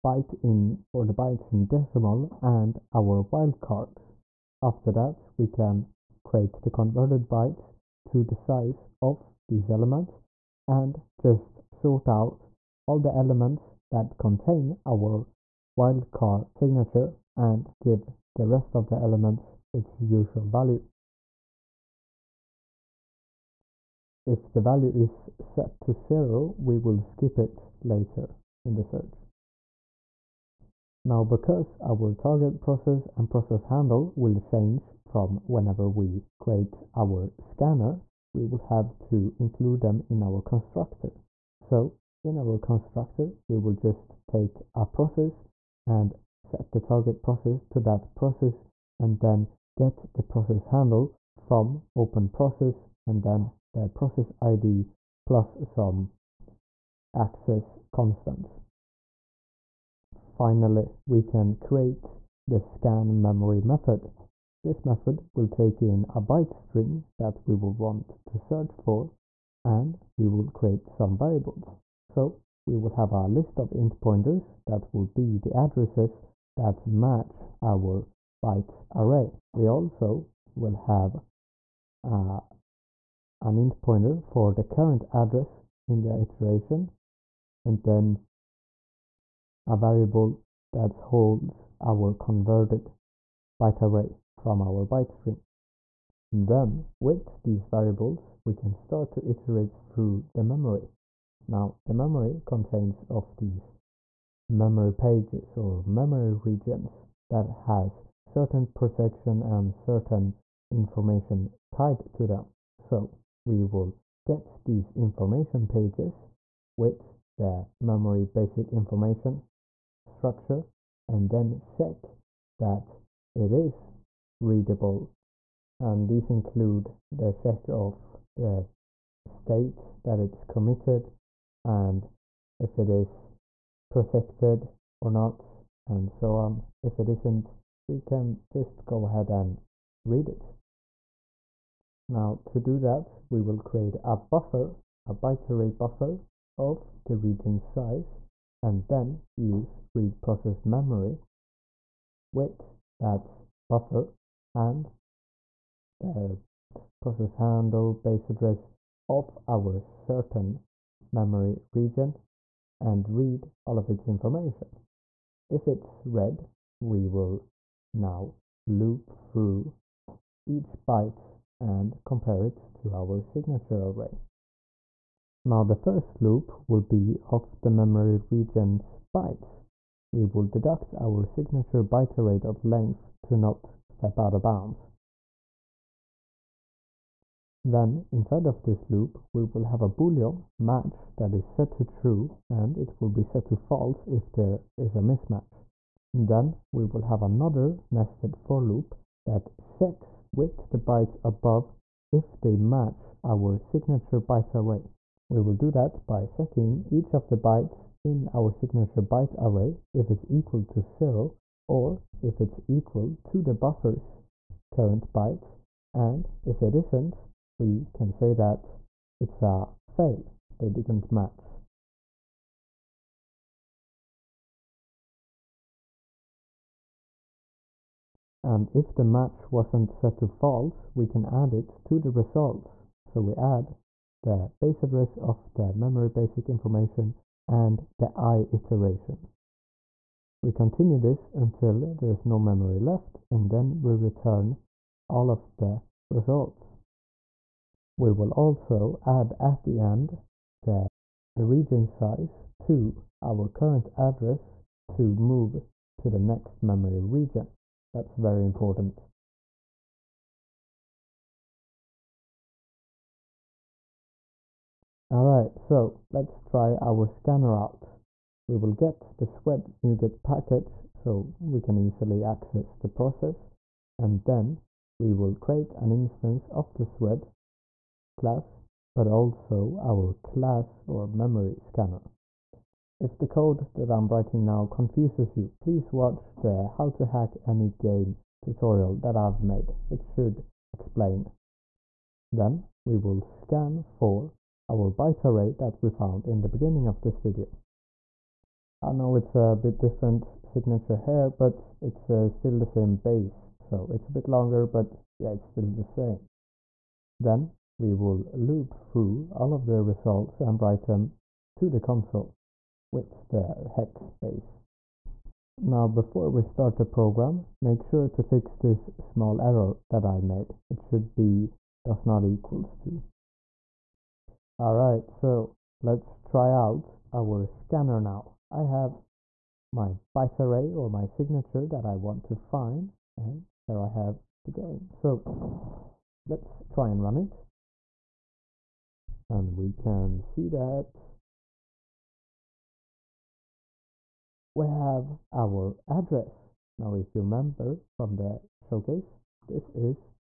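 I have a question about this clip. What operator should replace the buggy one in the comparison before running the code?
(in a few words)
does not equals to.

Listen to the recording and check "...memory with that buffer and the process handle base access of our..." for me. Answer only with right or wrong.
wrong.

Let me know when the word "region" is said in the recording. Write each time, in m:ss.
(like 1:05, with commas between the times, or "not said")
1:46, 2:27, 2:41, 2:58, 4:11, 4:17.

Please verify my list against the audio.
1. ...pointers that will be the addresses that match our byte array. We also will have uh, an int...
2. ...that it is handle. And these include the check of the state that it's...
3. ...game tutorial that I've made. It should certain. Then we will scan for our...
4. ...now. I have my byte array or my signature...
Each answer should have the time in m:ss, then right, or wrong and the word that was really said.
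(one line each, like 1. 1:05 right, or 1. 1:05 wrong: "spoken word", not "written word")
1. 1:14 right
2. 2:02 wrong: "readable", not "handle"
3. 4:47 wrong: "explain", not "certain"
4. 5:28 right.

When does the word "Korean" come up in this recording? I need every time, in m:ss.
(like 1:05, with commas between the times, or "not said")
not said.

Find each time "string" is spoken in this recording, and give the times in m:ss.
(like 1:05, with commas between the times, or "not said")
1:06, 1:35.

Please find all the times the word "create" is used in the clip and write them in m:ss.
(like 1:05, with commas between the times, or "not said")
0:06, 0:36, 1:01, 1:10, 2:23, 4:35.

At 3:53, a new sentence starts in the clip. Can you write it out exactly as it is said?
So we add the base address of the memory basic information, and the i iteration.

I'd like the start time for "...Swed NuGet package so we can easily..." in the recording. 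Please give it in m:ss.
4:29.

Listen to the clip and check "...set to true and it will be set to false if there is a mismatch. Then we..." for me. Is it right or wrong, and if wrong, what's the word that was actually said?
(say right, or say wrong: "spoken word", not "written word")
right.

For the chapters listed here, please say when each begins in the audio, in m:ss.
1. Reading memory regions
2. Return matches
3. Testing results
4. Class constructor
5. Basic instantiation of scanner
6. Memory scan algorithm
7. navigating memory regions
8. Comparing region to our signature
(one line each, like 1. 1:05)
1. 2:34
2. 4:01
3. 5:34
4. 0:44
5. 4:41
6. 1:09
7. 1:49
8. 2:59.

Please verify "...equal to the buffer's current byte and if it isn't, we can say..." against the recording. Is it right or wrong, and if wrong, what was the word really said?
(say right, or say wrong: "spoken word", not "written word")
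right.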